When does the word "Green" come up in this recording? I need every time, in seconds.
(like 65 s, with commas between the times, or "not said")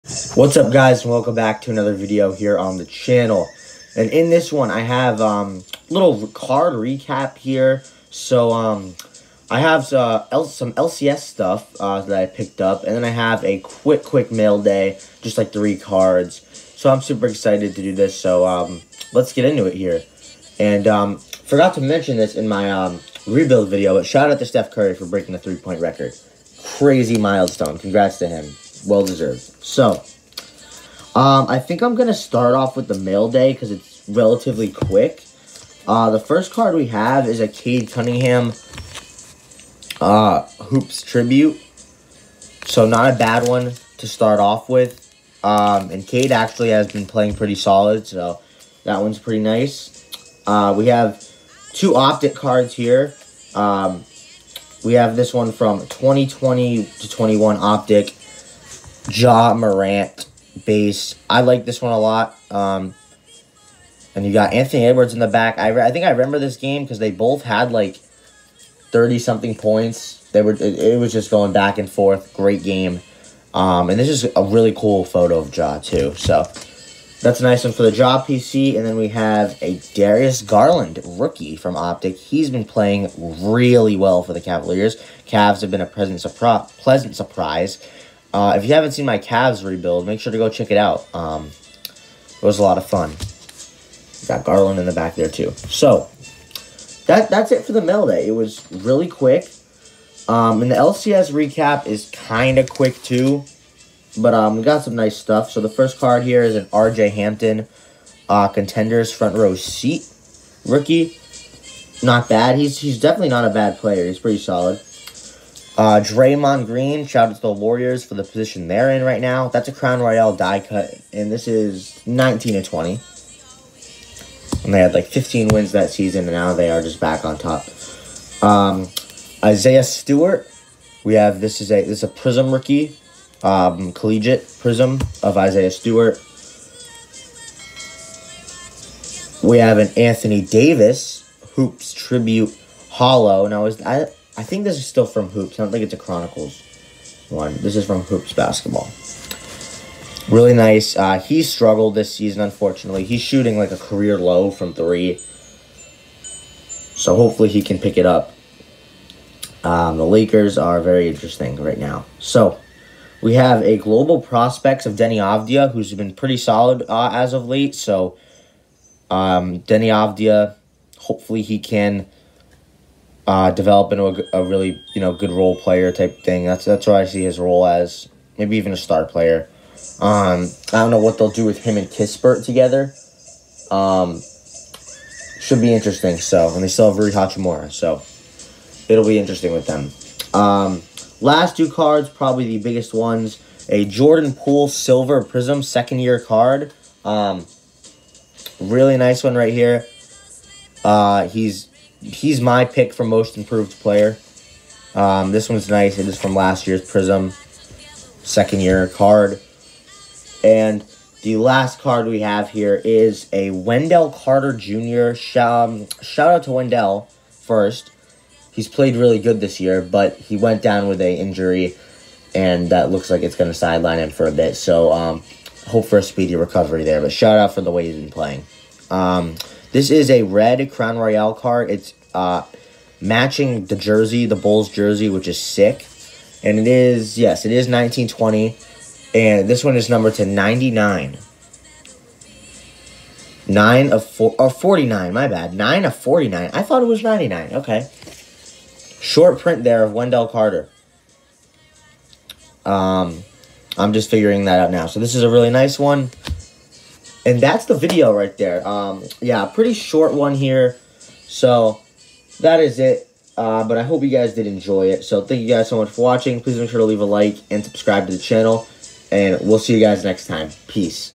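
116 s.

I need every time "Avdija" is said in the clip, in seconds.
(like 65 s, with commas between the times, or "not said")
165 s, 169 s.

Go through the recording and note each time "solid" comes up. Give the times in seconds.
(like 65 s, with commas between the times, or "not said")
47 s, 114 s, 166 s.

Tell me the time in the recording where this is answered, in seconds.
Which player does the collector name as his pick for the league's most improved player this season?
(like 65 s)
193 s.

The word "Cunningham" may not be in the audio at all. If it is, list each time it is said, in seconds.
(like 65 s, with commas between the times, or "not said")
37 s.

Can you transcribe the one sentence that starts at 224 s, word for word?
So um, hope for a speedy recovery there.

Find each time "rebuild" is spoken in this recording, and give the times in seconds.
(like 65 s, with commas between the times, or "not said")
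23 s, 89 s.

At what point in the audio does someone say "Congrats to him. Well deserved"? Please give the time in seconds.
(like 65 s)
27 s.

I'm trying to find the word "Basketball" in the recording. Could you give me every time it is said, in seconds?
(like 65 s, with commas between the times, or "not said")
148 s.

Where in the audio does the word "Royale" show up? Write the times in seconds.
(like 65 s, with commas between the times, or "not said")
120 s, 230 s.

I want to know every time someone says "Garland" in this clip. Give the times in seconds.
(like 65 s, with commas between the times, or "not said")
80 s, 94 s.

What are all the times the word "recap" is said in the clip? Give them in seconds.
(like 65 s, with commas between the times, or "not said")
6 s, 101 s.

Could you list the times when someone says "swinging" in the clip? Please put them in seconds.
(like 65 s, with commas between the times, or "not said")
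not said.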